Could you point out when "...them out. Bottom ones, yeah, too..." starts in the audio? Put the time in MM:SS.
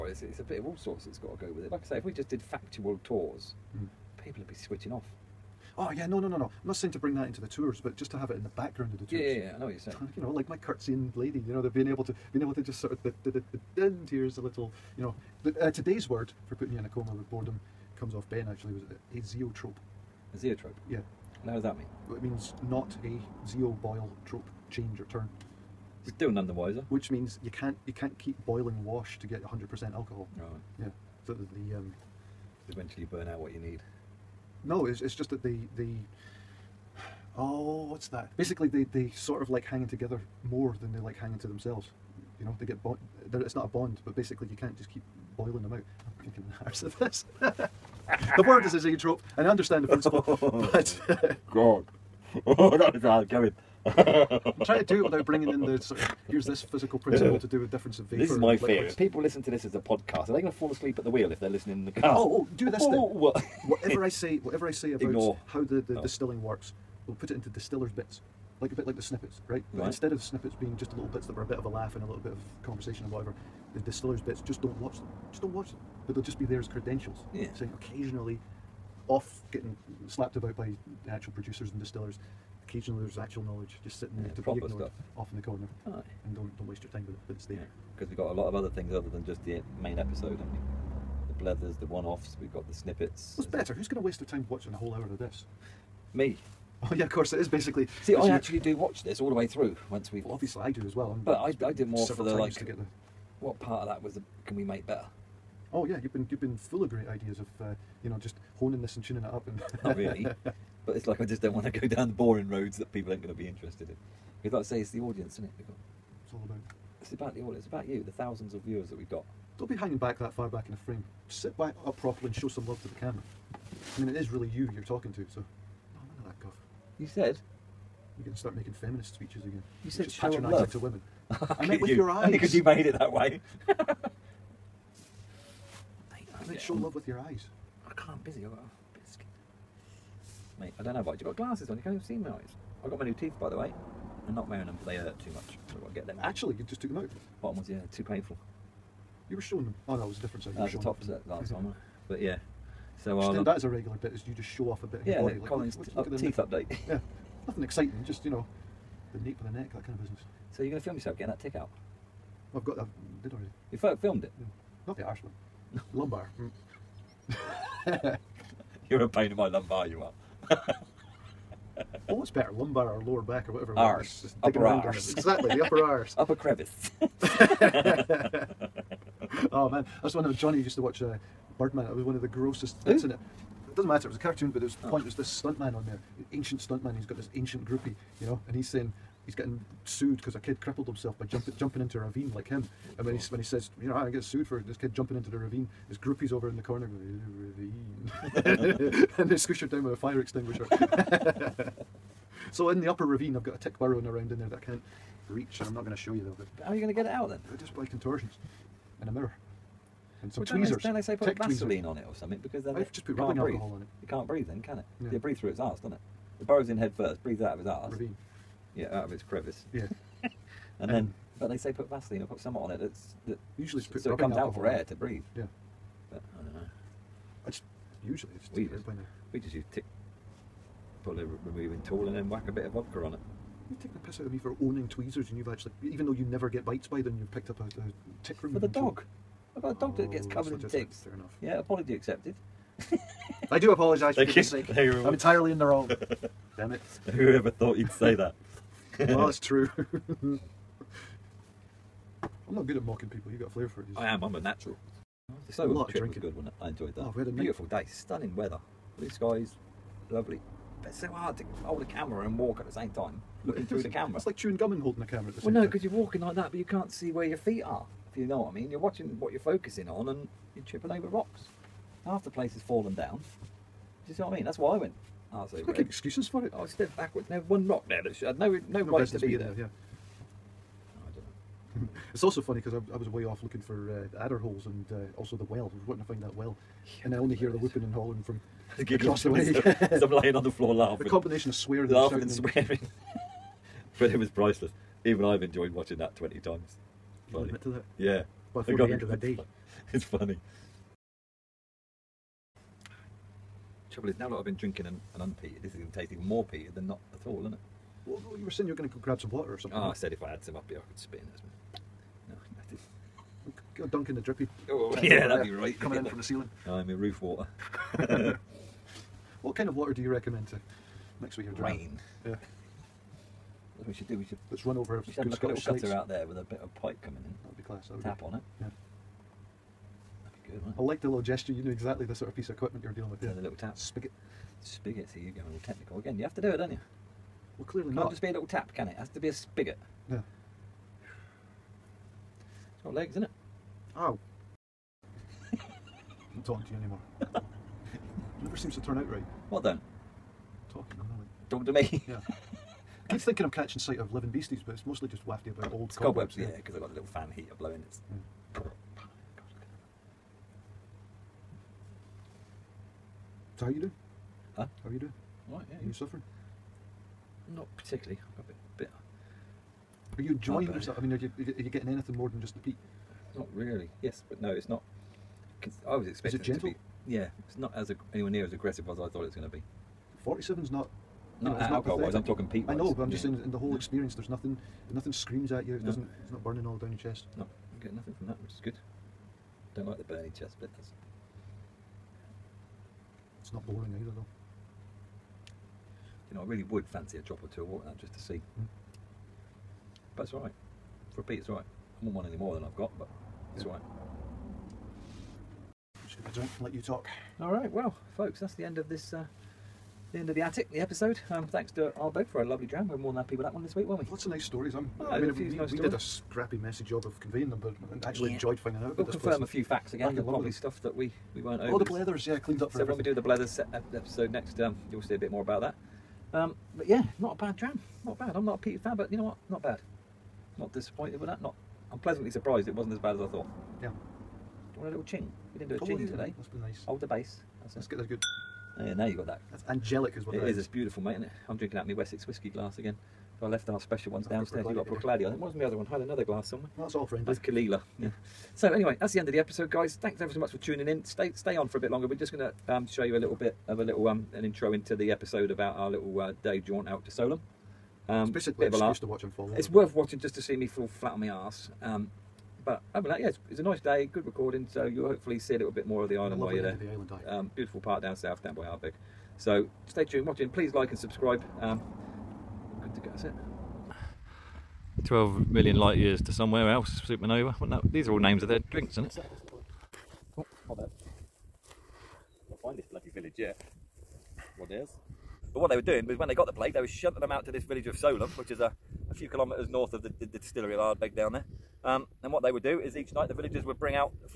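02:26.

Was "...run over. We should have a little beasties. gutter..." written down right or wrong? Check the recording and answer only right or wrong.
wrong.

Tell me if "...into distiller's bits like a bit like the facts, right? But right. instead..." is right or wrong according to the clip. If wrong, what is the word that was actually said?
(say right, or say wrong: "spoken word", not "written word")
wrong: "snippets", not "facts".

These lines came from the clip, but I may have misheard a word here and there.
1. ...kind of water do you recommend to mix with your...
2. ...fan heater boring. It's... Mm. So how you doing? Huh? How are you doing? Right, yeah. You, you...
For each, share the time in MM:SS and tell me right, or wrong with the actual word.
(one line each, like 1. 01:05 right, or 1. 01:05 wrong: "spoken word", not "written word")
1. 05:19 right
2. 05:57 wrong: "blowing", not "boring".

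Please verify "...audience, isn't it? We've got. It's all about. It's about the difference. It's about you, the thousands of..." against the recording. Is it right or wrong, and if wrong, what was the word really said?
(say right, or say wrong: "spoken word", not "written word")
wrong: "audience", not "difference".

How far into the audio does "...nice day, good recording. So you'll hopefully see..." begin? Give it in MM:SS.
07:43.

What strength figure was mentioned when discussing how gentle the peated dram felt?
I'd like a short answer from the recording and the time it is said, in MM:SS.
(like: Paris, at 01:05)
47, at 06:20.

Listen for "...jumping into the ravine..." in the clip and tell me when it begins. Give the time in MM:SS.
03:14.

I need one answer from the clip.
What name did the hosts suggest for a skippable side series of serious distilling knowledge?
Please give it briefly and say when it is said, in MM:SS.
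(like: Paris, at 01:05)
distillers bits, at 01:13.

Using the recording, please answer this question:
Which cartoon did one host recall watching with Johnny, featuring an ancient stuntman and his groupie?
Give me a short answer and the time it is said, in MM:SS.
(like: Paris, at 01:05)
Birdman, at 03:01.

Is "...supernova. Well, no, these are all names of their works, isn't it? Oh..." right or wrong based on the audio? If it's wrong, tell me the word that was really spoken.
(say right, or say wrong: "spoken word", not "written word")
wrong: "drinks", not "works".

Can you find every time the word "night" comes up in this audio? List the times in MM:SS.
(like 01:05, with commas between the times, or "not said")
04:17, 08:13.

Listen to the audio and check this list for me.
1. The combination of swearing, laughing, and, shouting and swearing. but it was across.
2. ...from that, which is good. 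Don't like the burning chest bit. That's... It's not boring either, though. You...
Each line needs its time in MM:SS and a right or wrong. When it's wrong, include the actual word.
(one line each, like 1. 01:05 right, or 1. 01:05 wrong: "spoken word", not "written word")
1. 04:51 wrong: "priceless", not "across"
2. 06:28 right.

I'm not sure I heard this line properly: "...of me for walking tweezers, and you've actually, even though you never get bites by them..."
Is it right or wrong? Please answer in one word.
wrong.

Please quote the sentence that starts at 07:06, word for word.
Um, but yeah, not a bad dram.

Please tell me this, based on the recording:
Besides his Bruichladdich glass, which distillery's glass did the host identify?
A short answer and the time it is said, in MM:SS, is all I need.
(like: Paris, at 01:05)
Caol Ila, at 07:27.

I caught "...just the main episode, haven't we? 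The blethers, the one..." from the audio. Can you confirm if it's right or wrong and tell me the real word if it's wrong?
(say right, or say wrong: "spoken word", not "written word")
right.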